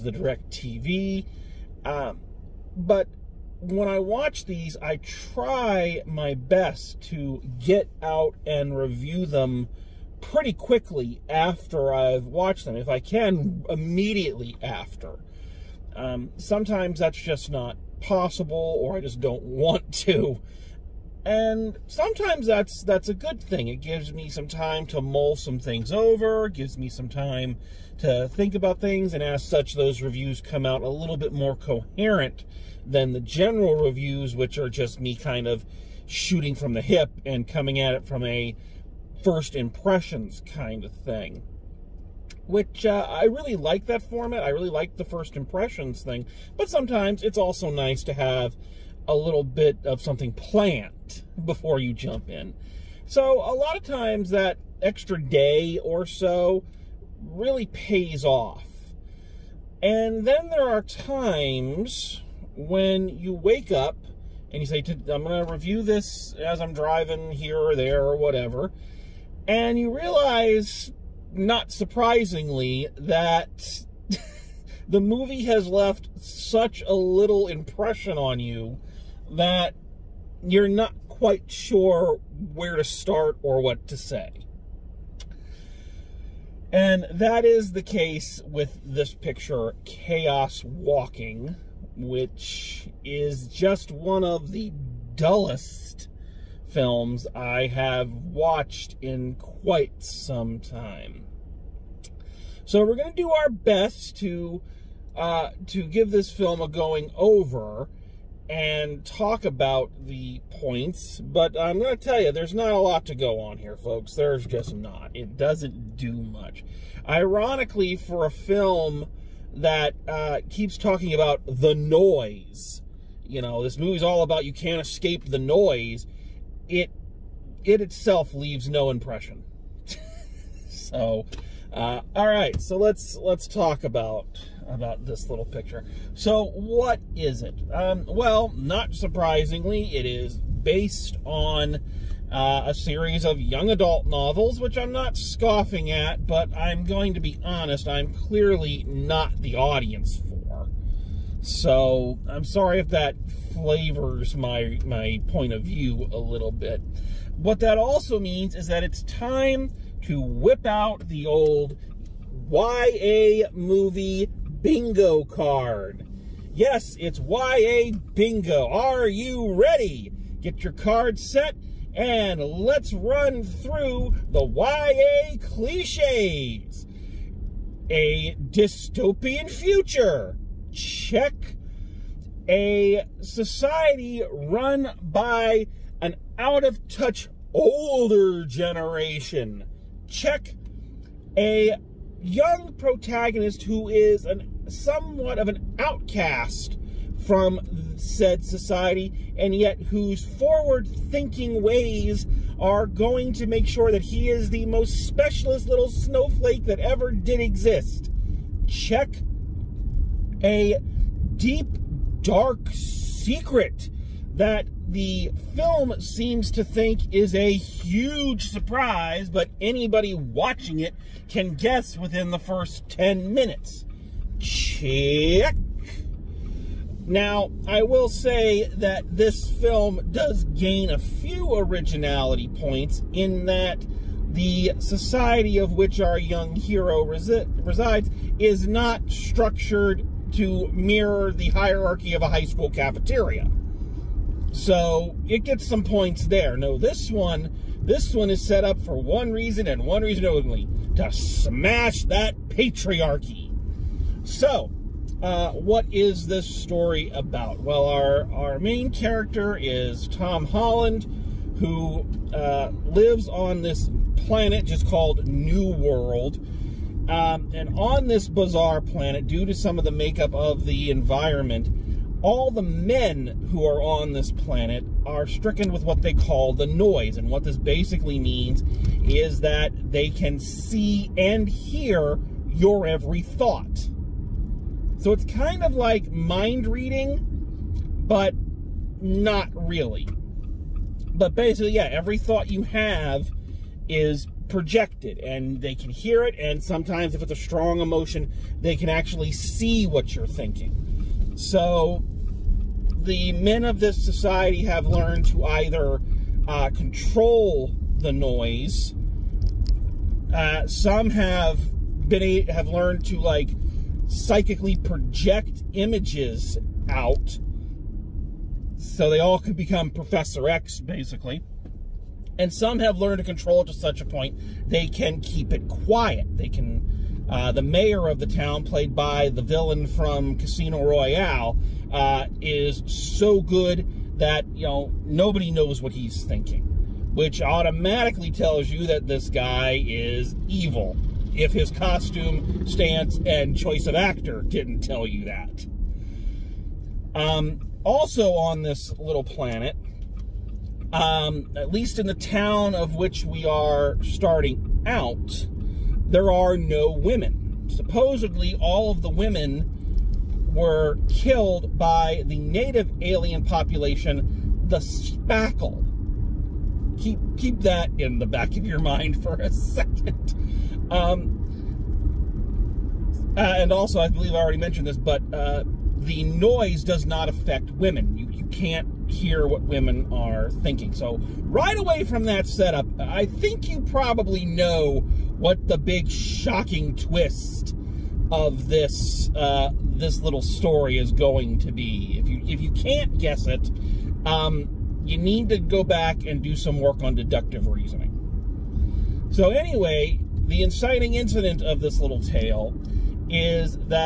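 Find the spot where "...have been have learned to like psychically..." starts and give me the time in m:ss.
5:11.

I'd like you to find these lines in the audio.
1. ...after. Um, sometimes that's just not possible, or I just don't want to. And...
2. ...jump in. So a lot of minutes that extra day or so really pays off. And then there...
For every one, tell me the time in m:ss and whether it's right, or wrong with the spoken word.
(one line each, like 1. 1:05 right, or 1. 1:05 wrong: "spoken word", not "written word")
1. 0:14 right
2. 0:51 wrong: "times", not "minutes".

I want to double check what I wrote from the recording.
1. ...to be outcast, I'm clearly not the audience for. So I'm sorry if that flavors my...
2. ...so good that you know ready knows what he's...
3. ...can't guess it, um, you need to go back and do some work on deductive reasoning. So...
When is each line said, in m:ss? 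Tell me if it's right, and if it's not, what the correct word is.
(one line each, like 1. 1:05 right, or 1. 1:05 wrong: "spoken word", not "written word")
1. 2:27 wrong: "honest", not "outcast"
2. 5:32 wrong: "nobody", not "ready"
3. 6:32 right.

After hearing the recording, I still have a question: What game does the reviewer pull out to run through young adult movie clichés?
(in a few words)
YA movie bingo.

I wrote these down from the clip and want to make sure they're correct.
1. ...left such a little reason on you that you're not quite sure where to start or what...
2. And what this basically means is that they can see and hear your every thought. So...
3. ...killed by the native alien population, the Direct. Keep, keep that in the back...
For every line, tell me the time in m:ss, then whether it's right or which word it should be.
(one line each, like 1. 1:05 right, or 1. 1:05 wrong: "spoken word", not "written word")
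1. 1:15 wrong: "impression", not "reason"
2. 4:37 right
3. 6:01 wrong: "Spackle", not "Direct".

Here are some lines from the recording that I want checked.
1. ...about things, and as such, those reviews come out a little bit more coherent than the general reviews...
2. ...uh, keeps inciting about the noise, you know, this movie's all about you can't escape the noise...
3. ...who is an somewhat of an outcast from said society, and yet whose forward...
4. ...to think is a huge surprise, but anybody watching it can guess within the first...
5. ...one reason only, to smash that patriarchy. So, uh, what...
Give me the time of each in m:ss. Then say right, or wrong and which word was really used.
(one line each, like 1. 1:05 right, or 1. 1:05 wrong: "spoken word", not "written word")
1. 0:28 right
2. 2:00 wrong: "talking", not "inciting"
3. 3:13 right
4. 3:36 right
5. 4:09 right.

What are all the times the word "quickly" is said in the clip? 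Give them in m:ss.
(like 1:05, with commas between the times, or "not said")
0:10.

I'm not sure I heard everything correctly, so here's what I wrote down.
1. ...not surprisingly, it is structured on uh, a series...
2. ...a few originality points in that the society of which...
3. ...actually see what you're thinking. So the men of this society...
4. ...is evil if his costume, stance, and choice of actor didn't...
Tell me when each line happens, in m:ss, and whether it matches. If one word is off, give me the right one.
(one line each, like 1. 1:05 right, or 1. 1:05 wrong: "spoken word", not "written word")
1. 2:18 wrong: "based", not "structured"
2. 3:50 right
3. 4:58 right
4. 5:39 right.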